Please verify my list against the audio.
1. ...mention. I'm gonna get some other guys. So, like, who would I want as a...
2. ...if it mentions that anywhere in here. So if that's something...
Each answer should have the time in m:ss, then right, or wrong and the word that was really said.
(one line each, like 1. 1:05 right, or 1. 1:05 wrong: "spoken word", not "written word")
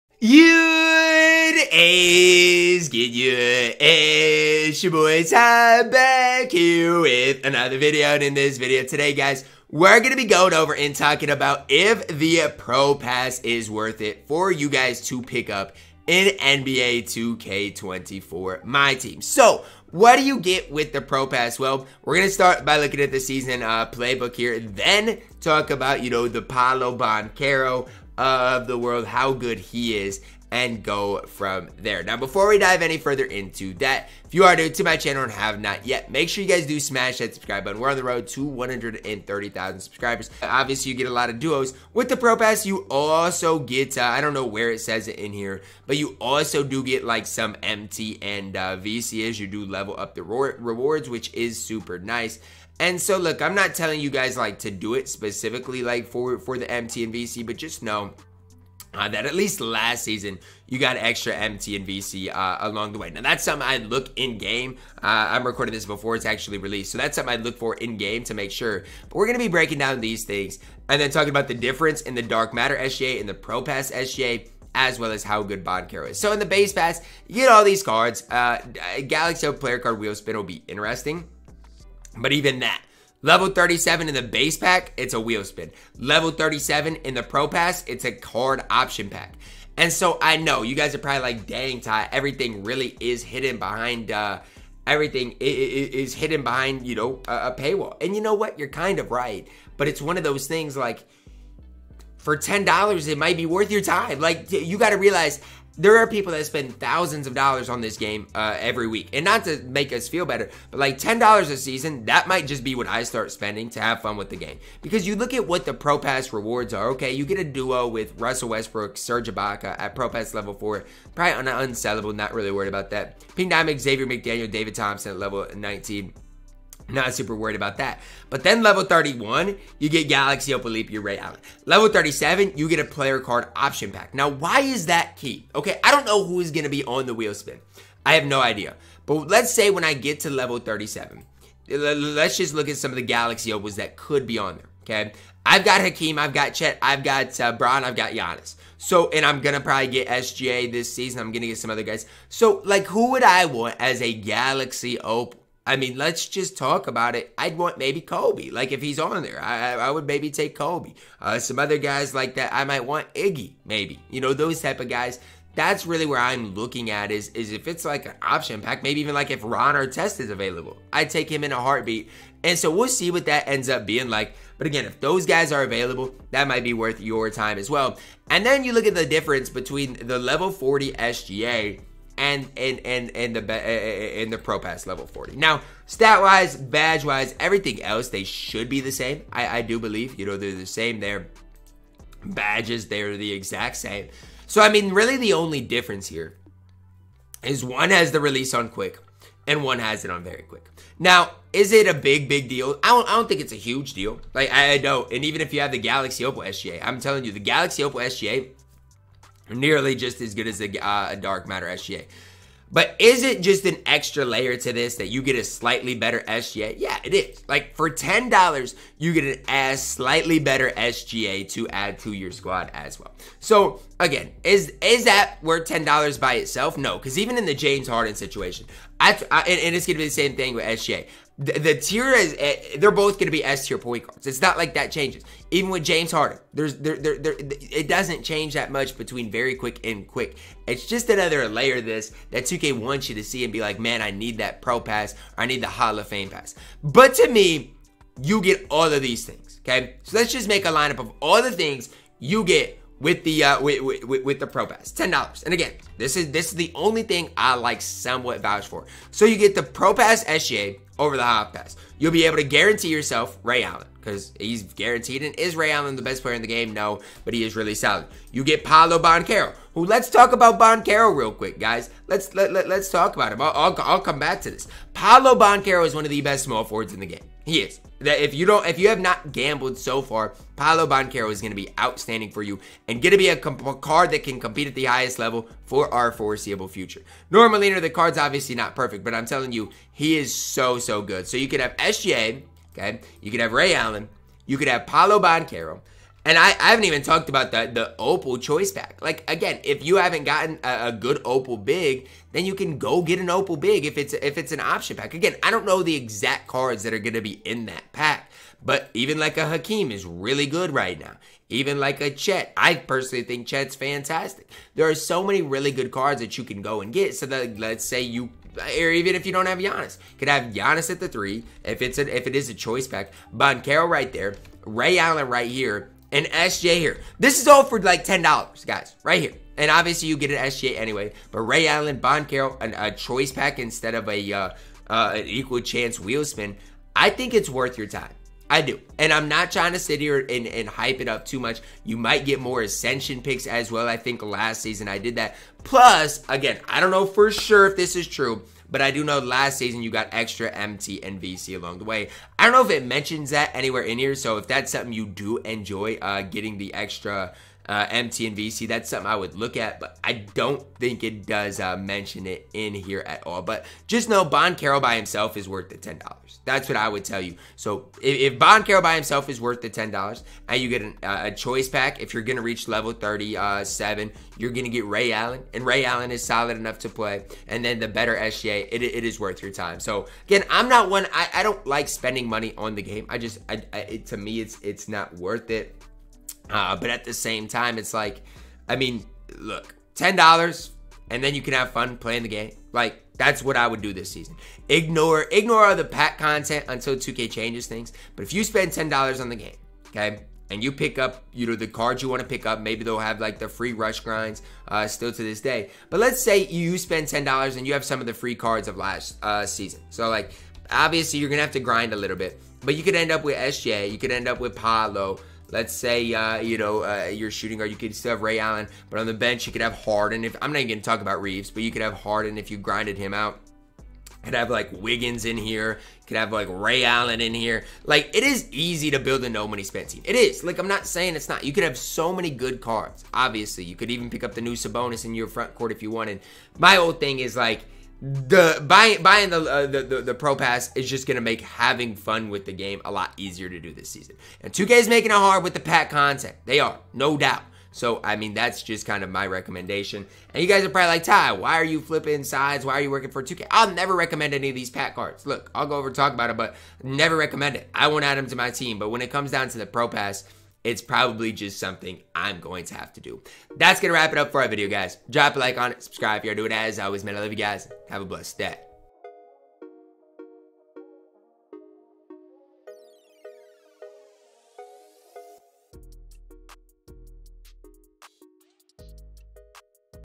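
1. 2:30 wrong: "season", not "mention"
2. 5:52 right.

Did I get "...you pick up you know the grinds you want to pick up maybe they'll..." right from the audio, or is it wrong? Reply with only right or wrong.
wrong.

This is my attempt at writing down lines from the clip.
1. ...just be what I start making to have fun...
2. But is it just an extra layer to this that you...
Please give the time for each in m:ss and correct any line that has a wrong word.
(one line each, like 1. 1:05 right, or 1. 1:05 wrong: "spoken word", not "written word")
1. 1:52 wrong: "spending", not "making"
2. 3:32 right.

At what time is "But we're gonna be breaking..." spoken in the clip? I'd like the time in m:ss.
1:09.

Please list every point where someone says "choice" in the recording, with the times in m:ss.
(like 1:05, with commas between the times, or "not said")
4:58, 5:22, 5:32, 6:11.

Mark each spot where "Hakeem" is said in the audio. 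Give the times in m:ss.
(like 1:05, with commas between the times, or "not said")
2:25, 5:09.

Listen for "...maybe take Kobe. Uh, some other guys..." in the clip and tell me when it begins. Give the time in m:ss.
2:40.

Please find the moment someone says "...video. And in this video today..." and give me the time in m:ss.
0:07.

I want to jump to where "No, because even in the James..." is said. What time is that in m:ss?
3:46.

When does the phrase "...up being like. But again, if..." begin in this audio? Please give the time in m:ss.
2:53.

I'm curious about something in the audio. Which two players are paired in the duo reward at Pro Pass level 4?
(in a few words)
Russell Westbrook, Serge Ibaka.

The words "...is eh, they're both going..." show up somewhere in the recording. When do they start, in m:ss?
3:52.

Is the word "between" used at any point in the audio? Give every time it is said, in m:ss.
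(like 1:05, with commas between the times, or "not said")
2:59, 3:58.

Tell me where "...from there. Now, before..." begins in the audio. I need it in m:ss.
0:31.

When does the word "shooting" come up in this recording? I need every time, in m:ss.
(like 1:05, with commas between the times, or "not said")
6:57.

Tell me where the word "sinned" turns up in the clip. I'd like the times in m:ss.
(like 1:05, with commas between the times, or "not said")
not said.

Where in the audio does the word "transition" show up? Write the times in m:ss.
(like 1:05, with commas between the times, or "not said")
not said.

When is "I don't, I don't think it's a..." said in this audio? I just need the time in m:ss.
3:22.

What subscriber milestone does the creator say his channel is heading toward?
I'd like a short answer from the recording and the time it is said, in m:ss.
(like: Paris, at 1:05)
130,000, at 0:38.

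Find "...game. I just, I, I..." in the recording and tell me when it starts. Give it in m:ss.
6:22.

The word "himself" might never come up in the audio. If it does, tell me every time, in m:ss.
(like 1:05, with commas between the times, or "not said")
6:04, 6:08.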